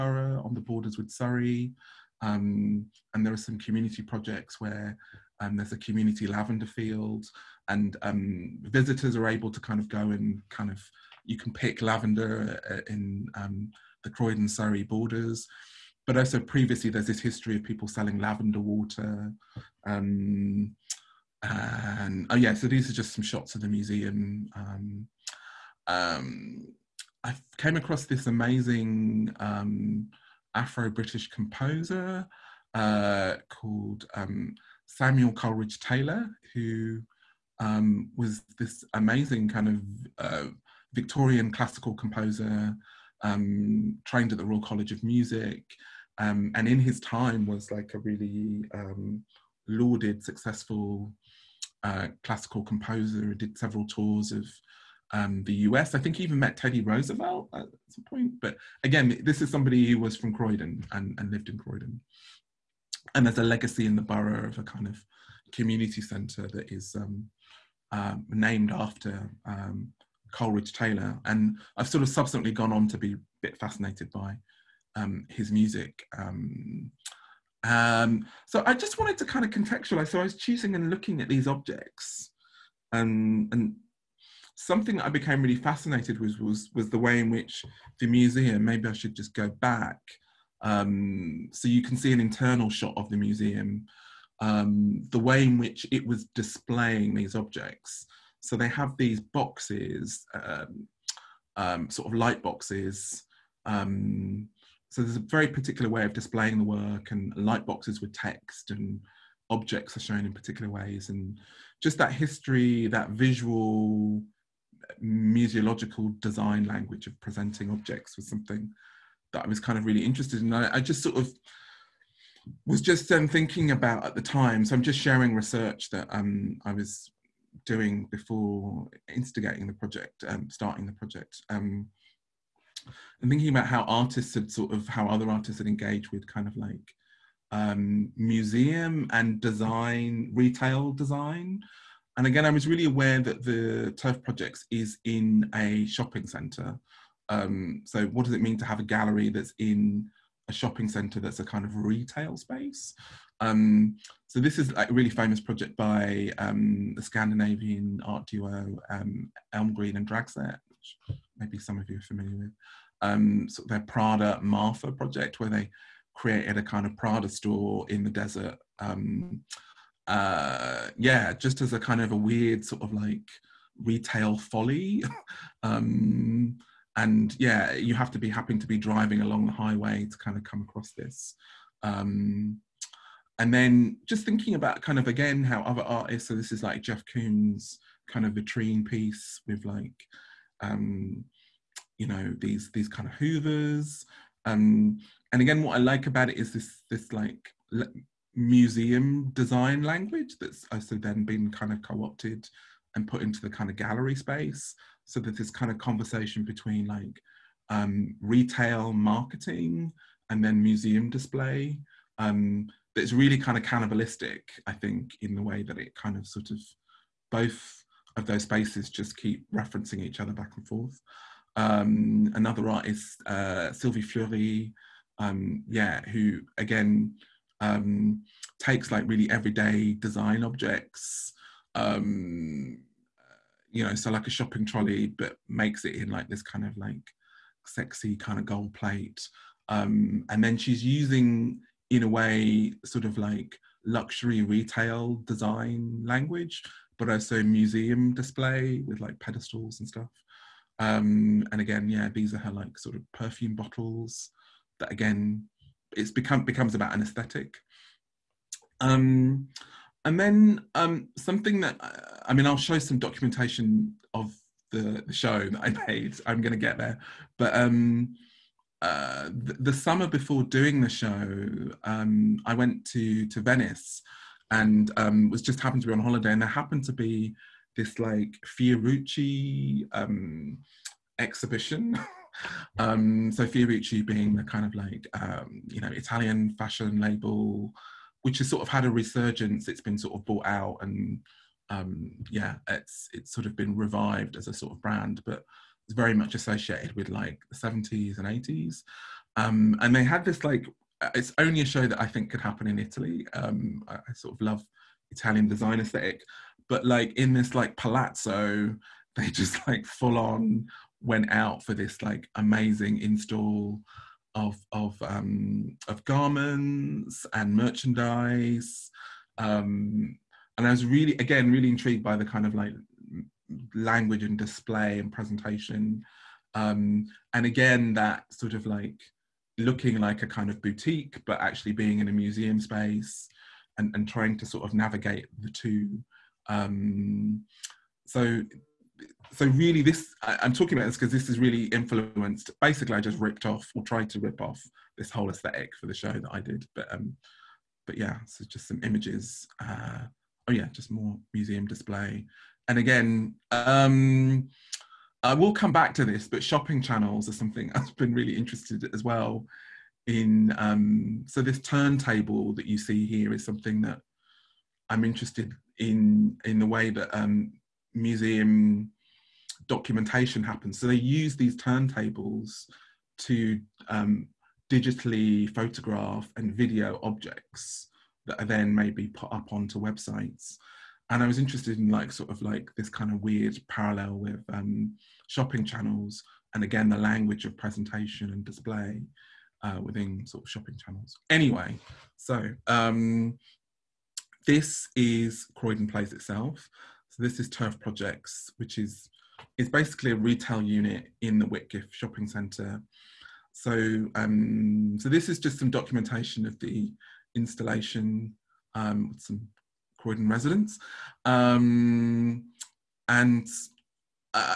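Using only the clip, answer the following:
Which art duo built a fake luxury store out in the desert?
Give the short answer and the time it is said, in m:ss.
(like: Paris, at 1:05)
Elmgreen and Dragset, at 2:39.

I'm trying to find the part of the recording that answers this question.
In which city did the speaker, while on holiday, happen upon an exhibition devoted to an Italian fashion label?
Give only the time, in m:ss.
4:33.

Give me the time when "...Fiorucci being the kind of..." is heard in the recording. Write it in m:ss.
4:43.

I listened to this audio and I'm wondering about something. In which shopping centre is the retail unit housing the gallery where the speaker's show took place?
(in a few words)
Whitgift shopping centre.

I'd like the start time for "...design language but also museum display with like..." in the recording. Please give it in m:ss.
4:05.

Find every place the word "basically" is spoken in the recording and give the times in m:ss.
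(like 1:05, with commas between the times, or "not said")
5:42, 6:39.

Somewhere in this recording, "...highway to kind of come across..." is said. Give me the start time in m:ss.
2:59.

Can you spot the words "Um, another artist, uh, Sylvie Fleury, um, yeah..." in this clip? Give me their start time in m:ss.
3:41.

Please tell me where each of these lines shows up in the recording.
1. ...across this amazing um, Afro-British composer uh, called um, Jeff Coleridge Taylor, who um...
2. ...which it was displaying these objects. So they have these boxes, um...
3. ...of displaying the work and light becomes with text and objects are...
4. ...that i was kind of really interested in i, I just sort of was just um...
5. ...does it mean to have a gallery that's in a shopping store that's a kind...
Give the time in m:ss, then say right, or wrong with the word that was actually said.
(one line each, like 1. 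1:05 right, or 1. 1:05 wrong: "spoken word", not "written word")
1. 0:27 wrong: "Samuel", not "Jeff"
2. 1:35 right
3. 1:46 wrong: "boxes", not "becomes"
4. 1:59 right
5. 2:28 wrong: "centre", not "store".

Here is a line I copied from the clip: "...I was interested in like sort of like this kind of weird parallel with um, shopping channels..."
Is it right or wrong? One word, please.
right.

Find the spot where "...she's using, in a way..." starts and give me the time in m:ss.
4:00.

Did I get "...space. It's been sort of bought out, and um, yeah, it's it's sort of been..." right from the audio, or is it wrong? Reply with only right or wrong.
wrong.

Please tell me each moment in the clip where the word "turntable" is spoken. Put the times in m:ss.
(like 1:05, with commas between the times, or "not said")
6:01, 6:11.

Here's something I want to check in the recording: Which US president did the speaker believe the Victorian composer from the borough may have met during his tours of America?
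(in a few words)
Teddy Roosevelt.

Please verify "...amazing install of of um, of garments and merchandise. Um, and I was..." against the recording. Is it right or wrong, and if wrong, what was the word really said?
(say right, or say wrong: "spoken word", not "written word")
right.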